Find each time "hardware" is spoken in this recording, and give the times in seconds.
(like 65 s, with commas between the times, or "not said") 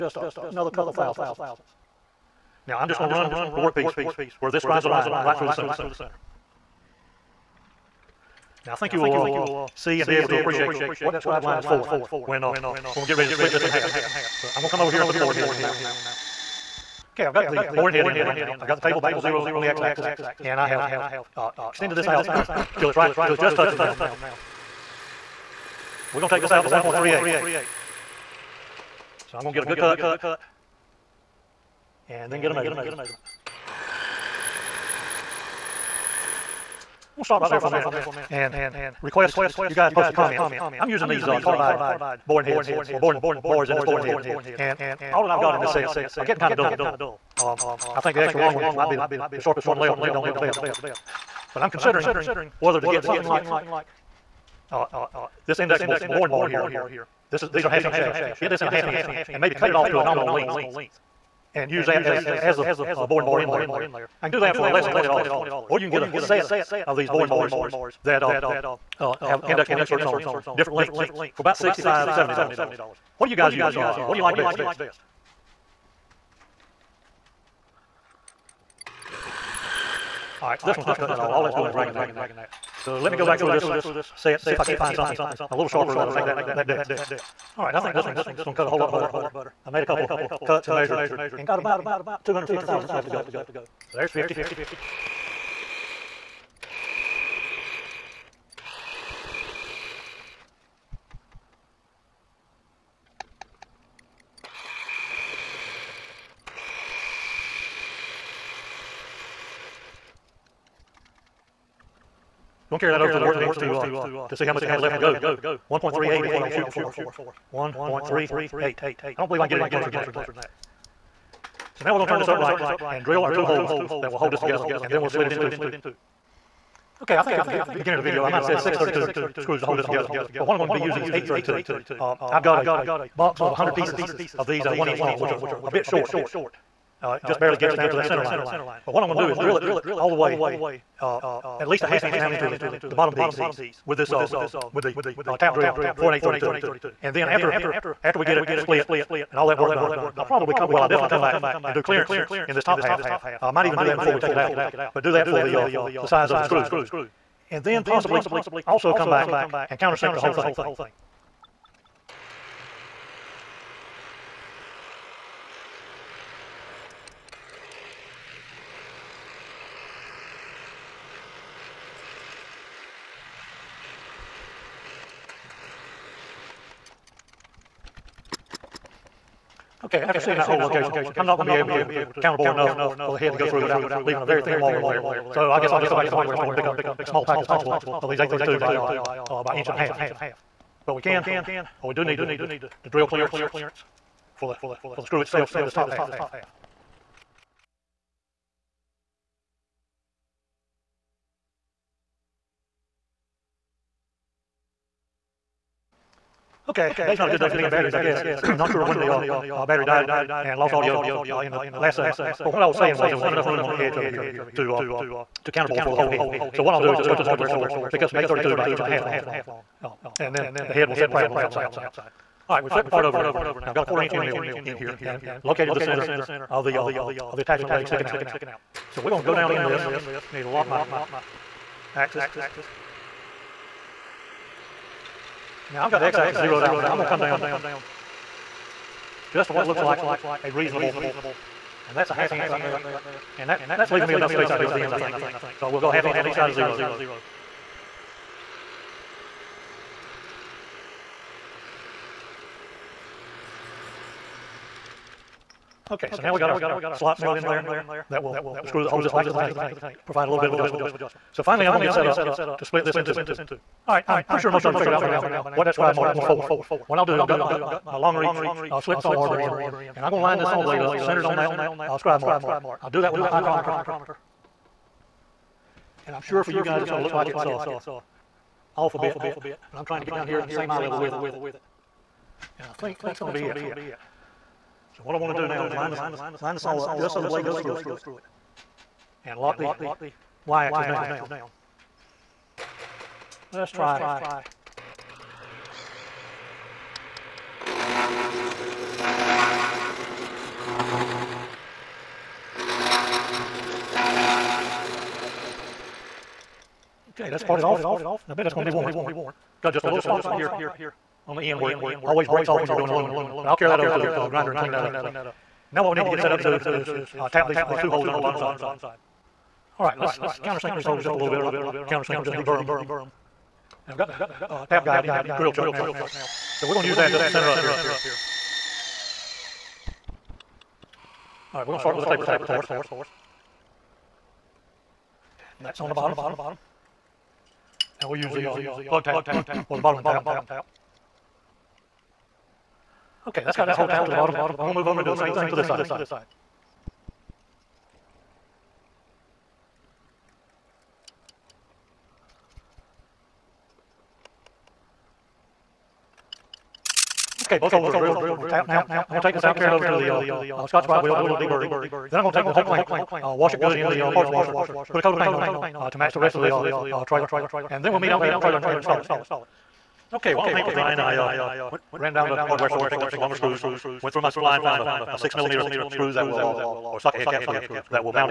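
186 s, 217 s, 372 s.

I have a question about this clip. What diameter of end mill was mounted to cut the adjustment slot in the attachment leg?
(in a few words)
quarter inch.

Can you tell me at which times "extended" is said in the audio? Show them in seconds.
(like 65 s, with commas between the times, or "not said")
21 s.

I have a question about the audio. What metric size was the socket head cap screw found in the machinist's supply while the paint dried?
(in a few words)
6 millimeter.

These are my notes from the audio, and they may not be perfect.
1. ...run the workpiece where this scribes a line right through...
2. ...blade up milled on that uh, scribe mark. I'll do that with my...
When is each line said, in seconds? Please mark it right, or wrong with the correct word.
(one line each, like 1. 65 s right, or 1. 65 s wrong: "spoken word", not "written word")
1. 3 s right
2. 270 s wrong: "centered", not "milled".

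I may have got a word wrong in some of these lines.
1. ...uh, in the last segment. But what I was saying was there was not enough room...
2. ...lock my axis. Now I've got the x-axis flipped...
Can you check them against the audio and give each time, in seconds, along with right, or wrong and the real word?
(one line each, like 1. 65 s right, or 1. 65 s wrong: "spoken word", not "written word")
1. 211 s right
2. 230 s wrong: "zeroed", not "flipped".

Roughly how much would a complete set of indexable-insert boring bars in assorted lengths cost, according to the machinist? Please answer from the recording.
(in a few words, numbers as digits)
$65, $70.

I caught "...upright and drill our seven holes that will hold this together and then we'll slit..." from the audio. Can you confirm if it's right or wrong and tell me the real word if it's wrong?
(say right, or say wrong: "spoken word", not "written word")
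wrong: "two", not "seven".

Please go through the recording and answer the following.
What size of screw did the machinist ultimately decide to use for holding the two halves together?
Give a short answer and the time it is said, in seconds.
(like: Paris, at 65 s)
832, at 130 s.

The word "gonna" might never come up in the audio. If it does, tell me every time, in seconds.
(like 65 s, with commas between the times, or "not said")
88 s, 112 s.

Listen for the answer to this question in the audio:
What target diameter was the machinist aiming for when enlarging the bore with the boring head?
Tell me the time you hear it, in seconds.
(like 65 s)
115 s.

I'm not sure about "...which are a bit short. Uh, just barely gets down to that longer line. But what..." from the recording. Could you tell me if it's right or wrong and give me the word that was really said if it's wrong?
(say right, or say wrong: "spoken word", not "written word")
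wrong: "center", not "longer".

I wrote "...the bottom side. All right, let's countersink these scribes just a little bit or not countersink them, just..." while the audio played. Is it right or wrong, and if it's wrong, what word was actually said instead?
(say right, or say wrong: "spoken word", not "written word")
wrong: "holes", not "scribes".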